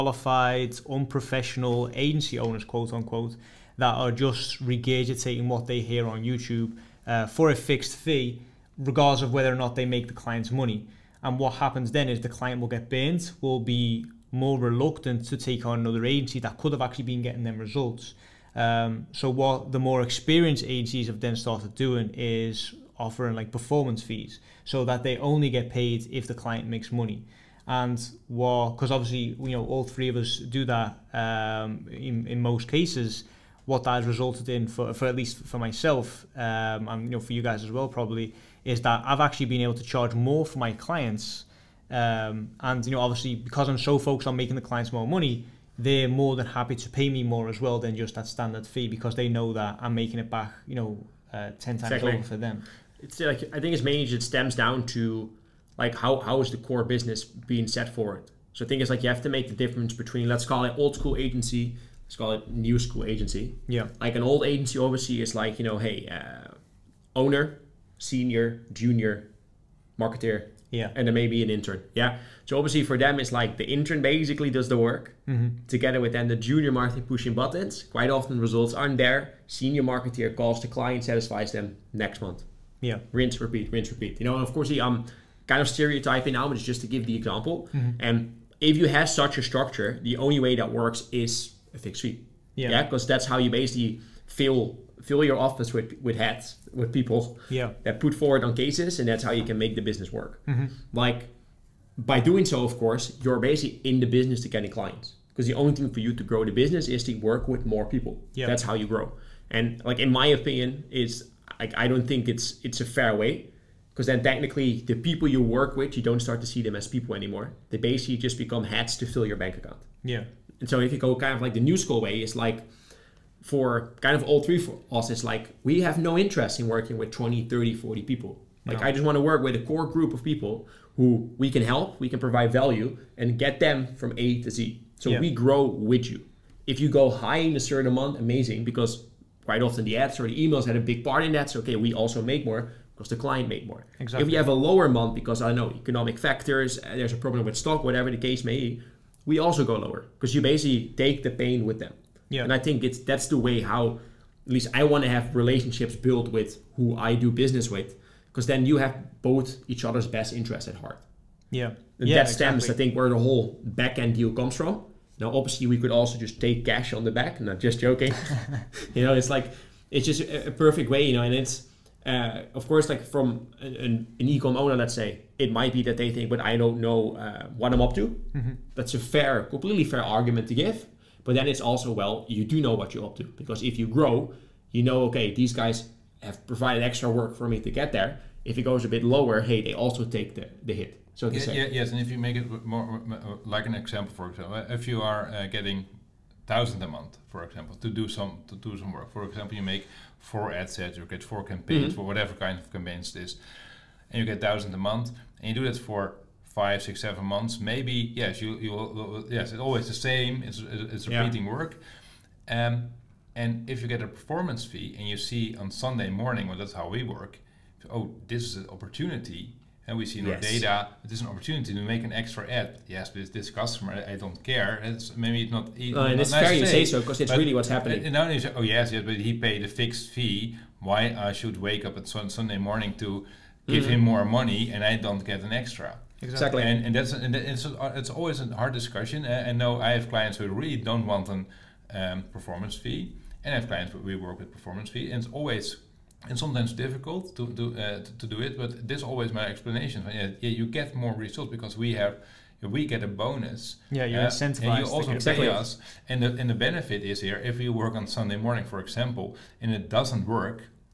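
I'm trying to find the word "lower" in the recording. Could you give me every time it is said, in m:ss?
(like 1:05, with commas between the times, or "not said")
2:24, 2:29, 3:09.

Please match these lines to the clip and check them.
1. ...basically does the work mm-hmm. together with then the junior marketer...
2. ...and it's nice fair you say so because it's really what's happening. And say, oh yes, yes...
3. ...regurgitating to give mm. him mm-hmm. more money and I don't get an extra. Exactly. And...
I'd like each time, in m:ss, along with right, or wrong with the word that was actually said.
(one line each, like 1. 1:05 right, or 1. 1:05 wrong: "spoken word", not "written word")
1. 1:14 right
2. 3:46 right
3. 3:52 wrong: "morning", not "regurgitating".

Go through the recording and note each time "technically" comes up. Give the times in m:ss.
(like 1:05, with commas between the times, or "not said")
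1:54.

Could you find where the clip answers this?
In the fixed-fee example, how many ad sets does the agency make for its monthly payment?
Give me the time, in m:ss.
3:20.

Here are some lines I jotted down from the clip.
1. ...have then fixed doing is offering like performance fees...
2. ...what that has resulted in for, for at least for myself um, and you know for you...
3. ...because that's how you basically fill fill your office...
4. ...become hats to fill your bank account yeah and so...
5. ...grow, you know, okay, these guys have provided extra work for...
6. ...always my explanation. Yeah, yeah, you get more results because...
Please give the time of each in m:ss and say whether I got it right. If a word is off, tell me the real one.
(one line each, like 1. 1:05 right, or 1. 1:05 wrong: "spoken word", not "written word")
1. 0:21 wrong: "started", not "fixed"
2. 0:33 right
3. 1:32 right
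4. 1:58 right
5. 3:03 right
6. 4:09 right.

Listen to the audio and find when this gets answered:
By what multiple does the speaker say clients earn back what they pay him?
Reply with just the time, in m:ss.
0:51.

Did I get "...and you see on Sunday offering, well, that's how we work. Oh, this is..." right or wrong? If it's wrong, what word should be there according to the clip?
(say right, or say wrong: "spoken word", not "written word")
wrong: "morning", not "offering".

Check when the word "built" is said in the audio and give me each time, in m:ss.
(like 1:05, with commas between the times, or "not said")
2:35.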